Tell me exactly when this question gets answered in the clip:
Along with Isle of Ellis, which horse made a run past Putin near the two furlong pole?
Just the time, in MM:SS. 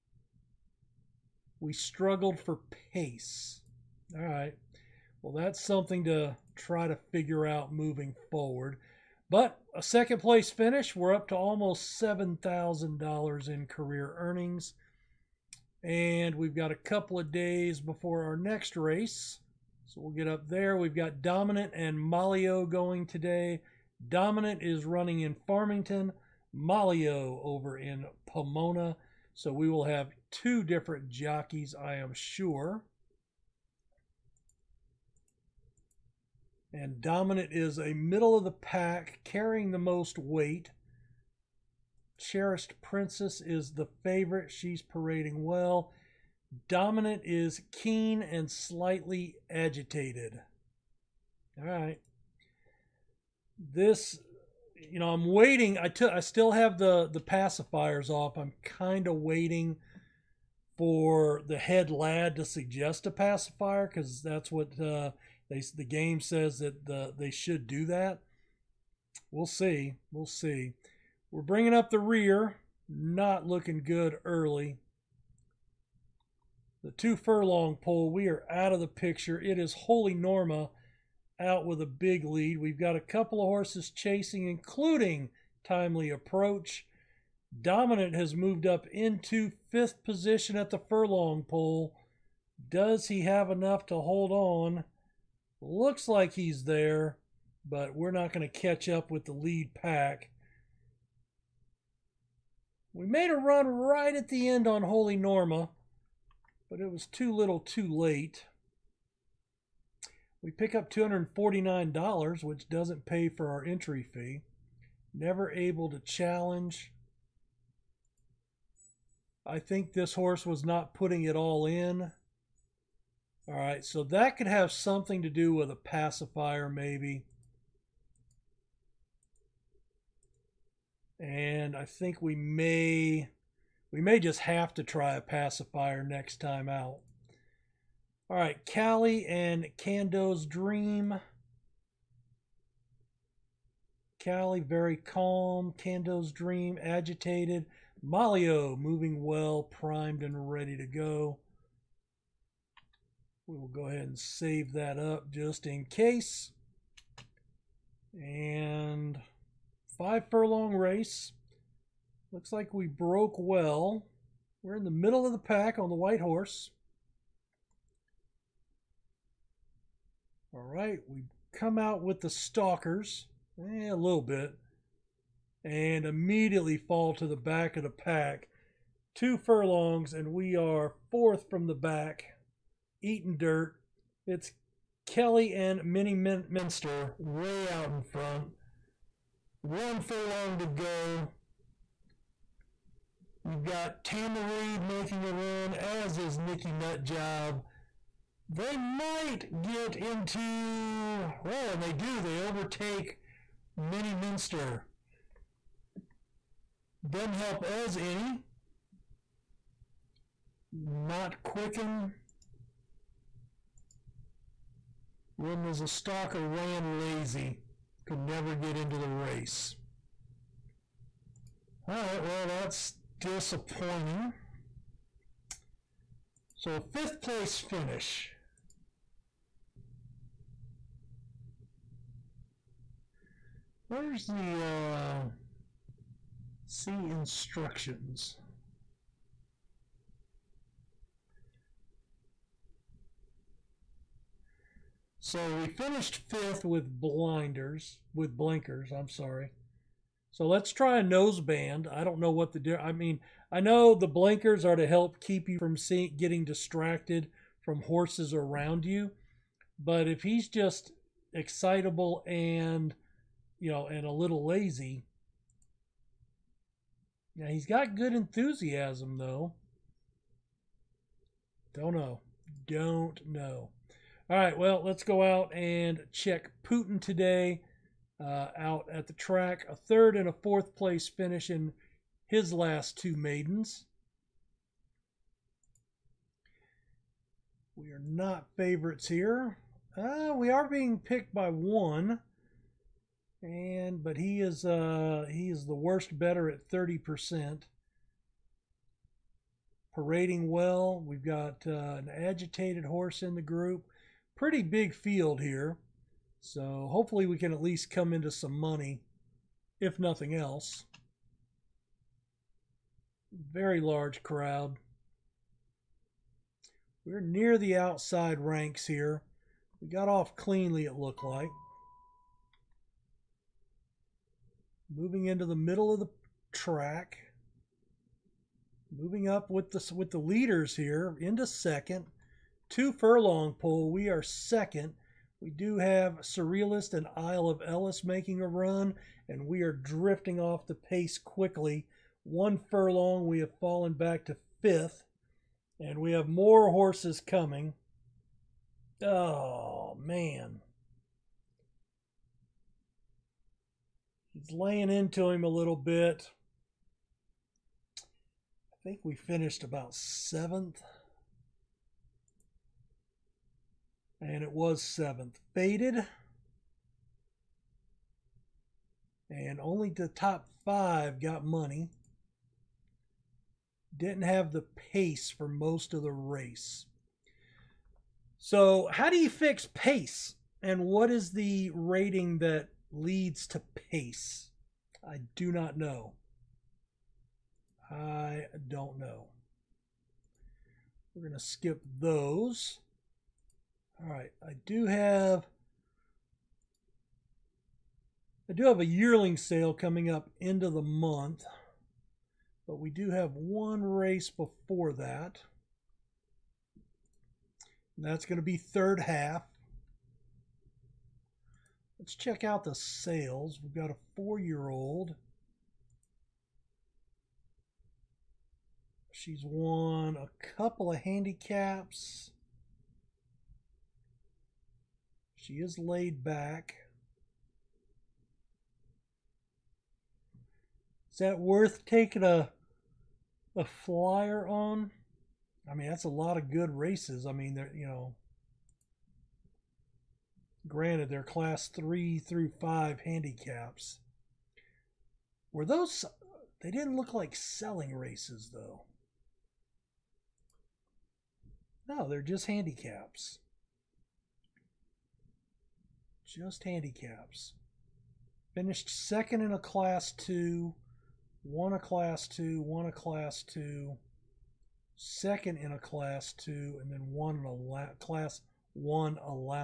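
05:36.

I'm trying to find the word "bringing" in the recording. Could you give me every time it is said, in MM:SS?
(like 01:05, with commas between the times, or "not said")
01:11.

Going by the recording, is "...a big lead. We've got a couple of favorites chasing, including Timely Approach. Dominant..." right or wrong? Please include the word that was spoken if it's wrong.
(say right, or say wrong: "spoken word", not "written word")
wrong: "horses", not "favorites".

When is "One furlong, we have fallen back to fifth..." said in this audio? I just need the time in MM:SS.
05:42.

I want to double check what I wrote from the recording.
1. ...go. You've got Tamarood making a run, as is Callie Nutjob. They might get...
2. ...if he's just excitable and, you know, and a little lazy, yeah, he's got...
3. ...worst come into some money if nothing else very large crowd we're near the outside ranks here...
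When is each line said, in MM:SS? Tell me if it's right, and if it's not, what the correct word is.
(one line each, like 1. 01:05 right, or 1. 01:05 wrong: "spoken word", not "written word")
1. 03:10 wrong: "Nicky", not "Callie"
2. 04:20 right
3. 05:07 wrong: "least", not "worst".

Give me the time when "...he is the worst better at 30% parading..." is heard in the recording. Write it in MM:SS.
04:55.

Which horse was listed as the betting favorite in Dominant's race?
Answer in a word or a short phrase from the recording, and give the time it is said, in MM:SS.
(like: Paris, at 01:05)
Cherished Princess, at 00:42.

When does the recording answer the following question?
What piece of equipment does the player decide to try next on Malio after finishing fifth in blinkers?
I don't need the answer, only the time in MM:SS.
04:11.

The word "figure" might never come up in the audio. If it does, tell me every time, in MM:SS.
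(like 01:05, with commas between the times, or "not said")
00:07.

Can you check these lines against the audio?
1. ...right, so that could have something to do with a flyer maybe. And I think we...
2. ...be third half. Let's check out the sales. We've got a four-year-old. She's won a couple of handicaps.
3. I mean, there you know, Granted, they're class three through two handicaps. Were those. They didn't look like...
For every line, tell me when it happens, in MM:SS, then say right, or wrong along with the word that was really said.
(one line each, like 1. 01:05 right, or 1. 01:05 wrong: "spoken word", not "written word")
1. 02:03 wrong: "pacifier", not "flyer"
2. 06:48 right
3. 07:17 wrong: "five", not "two".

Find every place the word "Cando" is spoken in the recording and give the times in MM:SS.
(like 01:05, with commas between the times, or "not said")
02:19, 02:25.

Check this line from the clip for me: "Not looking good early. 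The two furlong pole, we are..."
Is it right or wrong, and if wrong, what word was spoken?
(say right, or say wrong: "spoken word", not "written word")
right.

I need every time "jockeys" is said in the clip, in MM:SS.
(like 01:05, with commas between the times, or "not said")
00:31.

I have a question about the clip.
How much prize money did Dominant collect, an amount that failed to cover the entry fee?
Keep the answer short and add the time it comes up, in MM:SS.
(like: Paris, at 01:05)
$249, at 01:50.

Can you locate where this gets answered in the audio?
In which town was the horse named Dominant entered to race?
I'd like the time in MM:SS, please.
00:25.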